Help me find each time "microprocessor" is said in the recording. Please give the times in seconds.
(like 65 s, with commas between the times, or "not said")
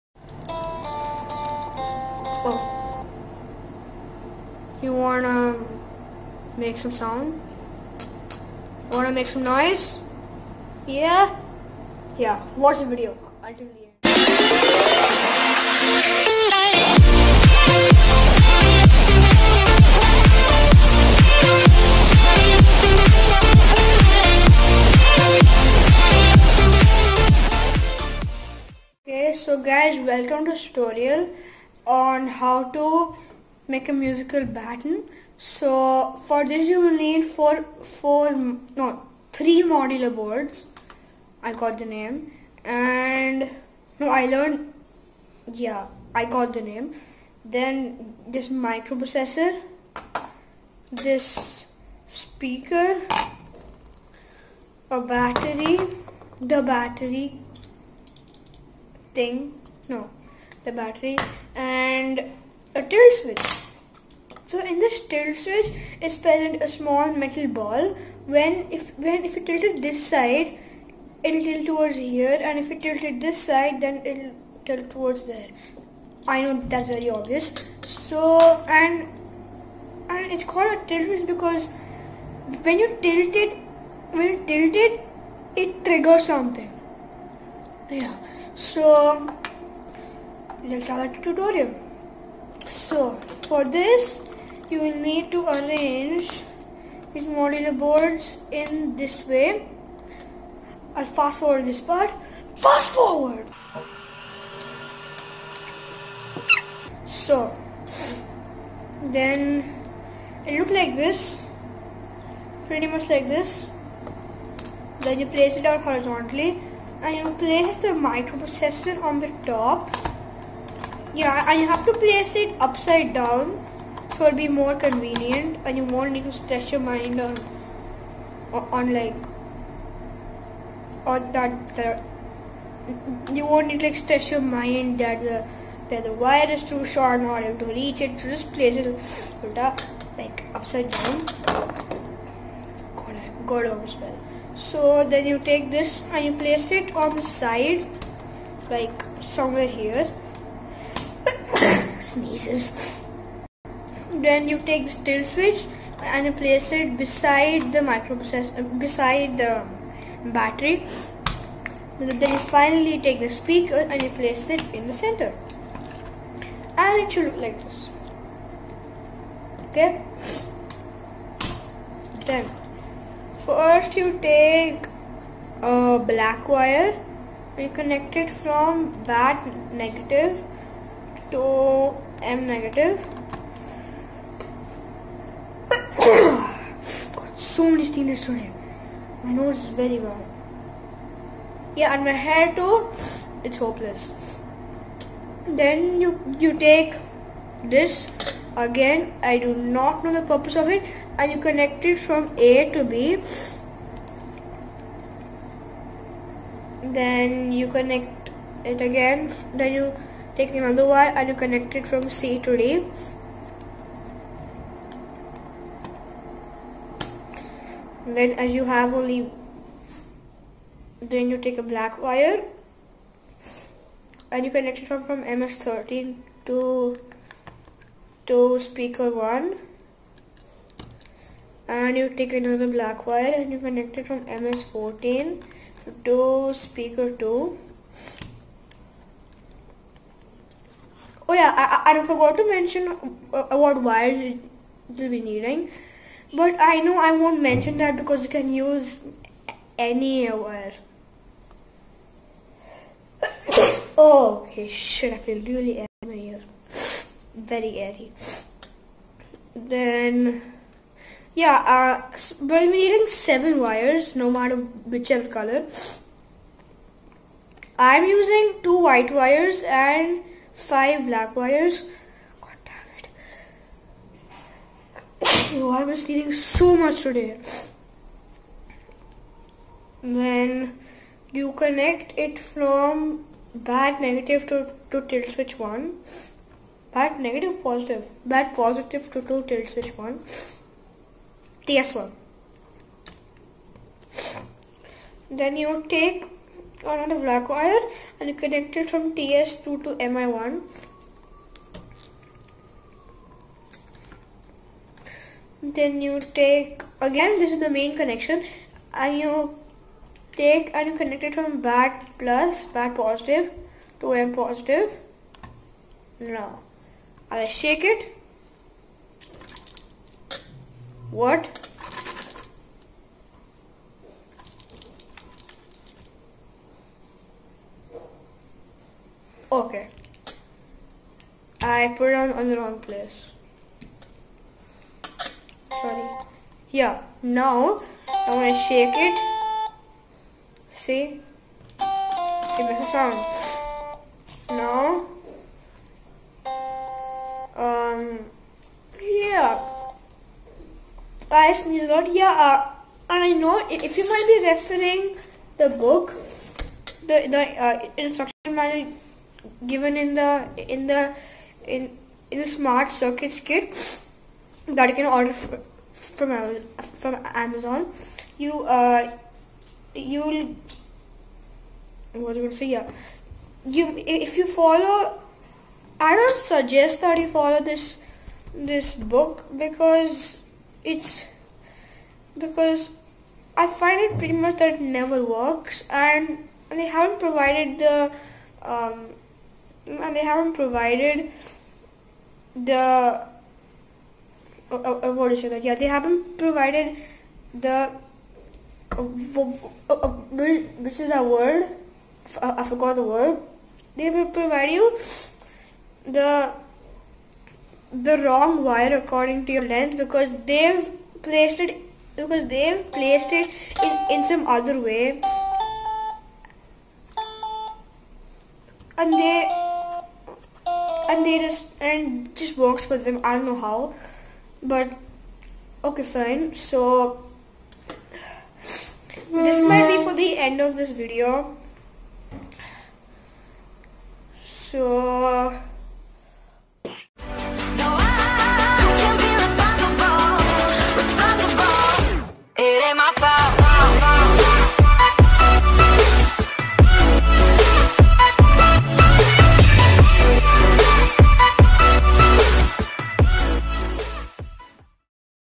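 48 s, 117 s, 157 s.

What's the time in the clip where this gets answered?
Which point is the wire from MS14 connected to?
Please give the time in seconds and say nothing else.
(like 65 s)
236 s.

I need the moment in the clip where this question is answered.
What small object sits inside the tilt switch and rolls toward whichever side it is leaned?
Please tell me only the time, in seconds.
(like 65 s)
66 s.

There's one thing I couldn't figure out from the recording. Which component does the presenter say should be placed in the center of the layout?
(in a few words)
the speaker.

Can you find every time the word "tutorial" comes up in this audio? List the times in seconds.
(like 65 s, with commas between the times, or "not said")
30 s, 91 s.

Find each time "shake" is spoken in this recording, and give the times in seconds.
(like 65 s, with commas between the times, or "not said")
317 s, 338 s.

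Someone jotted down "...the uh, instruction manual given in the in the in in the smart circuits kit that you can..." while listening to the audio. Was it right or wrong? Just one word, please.
right.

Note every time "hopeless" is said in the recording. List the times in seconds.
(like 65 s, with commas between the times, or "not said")
193 s.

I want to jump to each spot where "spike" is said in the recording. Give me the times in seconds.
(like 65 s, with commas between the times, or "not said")
not said.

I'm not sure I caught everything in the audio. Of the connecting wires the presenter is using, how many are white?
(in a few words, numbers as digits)
2.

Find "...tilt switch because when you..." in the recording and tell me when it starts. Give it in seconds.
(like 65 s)
80 s.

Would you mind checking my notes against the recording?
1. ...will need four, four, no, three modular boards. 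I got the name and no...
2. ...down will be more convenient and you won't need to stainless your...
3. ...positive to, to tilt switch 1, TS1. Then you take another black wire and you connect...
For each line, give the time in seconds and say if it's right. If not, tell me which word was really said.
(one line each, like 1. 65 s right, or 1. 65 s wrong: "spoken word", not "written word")
1. 36 s right
2. 123 s wrong: "stress", not "stainless"
3. 288 s right.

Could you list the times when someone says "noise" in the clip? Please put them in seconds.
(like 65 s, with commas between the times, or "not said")
9 s.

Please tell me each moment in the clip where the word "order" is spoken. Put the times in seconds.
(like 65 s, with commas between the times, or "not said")
137 s, 365 s.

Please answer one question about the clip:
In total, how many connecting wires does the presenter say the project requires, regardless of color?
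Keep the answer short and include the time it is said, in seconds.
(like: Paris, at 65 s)
7, at 263 s.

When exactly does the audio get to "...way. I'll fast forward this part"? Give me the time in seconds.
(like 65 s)
99 s.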